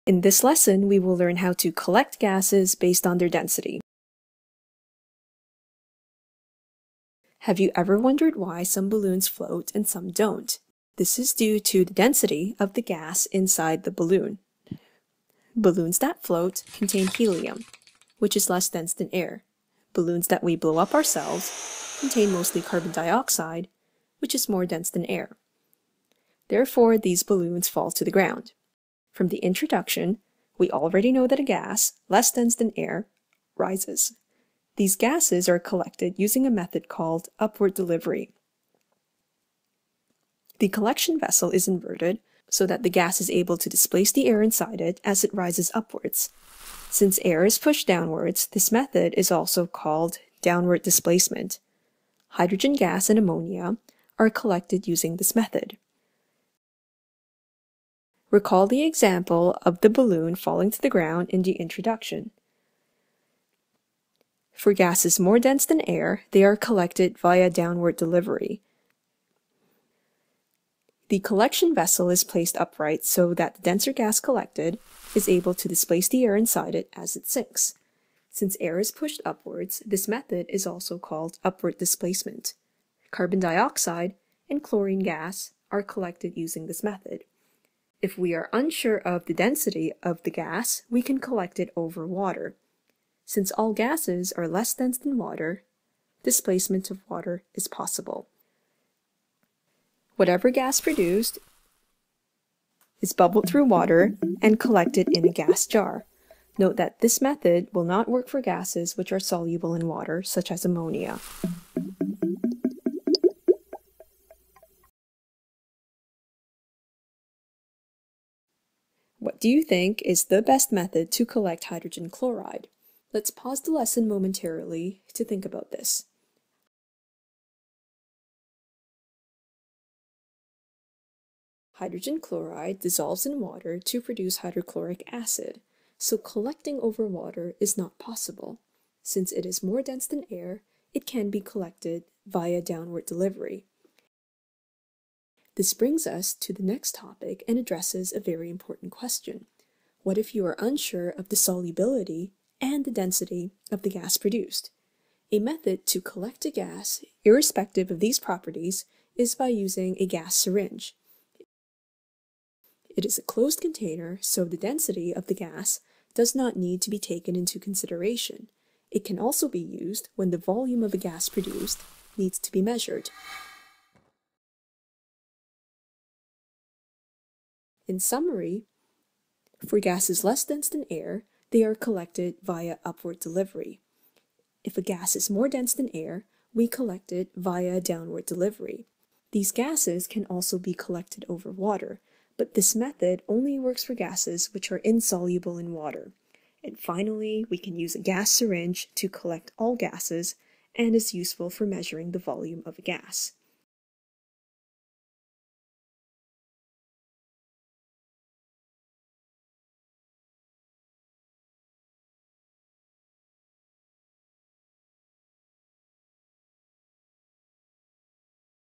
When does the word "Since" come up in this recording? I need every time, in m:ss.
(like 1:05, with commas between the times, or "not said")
0:46, 1:18, 1:33, 2:19.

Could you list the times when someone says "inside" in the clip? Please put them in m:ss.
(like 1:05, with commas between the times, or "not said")
0:13, 0:44, 1:16.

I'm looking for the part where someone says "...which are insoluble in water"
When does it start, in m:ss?
3:14.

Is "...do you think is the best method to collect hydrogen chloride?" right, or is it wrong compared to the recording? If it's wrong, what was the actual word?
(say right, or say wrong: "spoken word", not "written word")
right.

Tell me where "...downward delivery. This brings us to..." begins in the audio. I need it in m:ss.
2:22.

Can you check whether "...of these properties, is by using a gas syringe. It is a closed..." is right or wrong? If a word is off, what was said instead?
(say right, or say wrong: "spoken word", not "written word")
right.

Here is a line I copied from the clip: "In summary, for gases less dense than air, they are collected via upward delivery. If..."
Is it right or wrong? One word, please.
right.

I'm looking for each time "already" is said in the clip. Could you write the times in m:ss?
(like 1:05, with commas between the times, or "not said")
0:30.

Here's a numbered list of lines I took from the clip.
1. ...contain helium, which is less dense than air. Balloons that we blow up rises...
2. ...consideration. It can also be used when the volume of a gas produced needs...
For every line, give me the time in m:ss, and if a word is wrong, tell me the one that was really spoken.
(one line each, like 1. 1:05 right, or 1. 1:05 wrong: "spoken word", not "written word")
1. 0:16 wrong: "ourselves", not "rises"
2. 2:47 right.